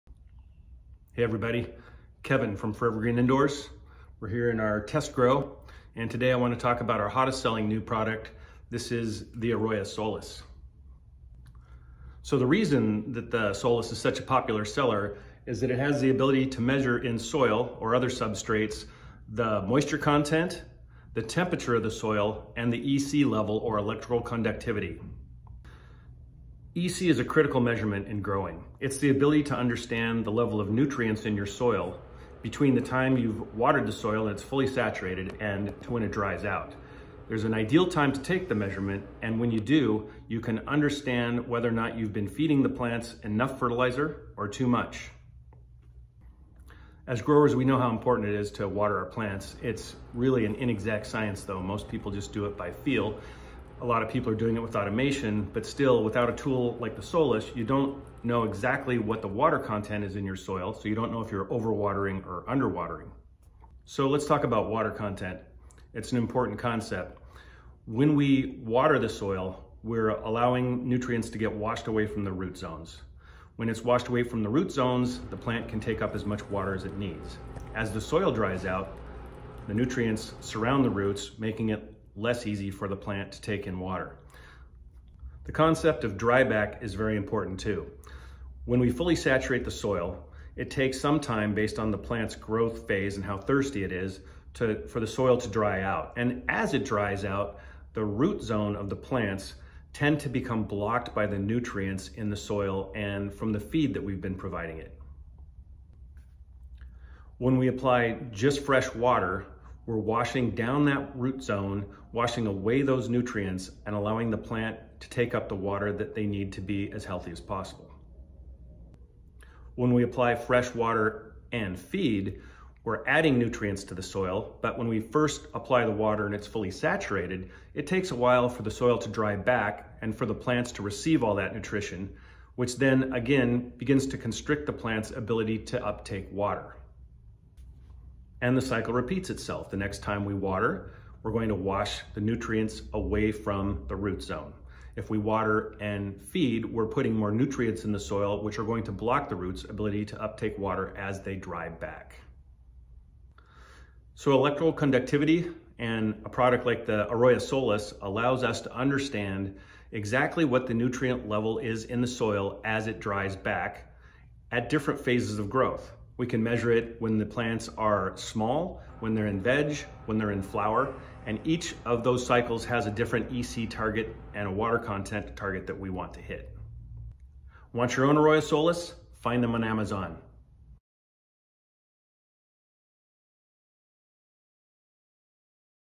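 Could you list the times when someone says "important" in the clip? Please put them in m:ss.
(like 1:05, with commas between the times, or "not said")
0:47, 1:06, 1:27.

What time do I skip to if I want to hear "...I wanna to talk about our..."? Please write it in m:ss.
0:06.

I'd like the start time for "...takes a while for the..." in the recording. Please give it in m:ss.
2:07.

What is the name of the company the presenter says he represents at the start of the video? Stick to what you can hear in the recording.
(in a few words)
Forever Green Indoors.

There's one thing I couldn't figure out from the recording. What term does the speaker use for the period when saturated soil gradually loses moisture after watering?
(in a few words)
dryback.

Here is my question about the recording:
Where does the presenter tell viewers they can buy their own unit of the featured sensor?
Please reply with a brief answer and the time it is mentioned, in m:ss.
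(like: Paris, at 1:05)
Amazon, at 2:59.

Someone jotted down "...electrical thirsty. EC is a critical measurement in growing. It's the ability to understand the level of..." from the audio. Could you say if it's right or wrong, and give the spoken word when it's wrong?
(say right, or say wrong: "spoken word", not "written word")
wrong: "conductivity", not "thirsty".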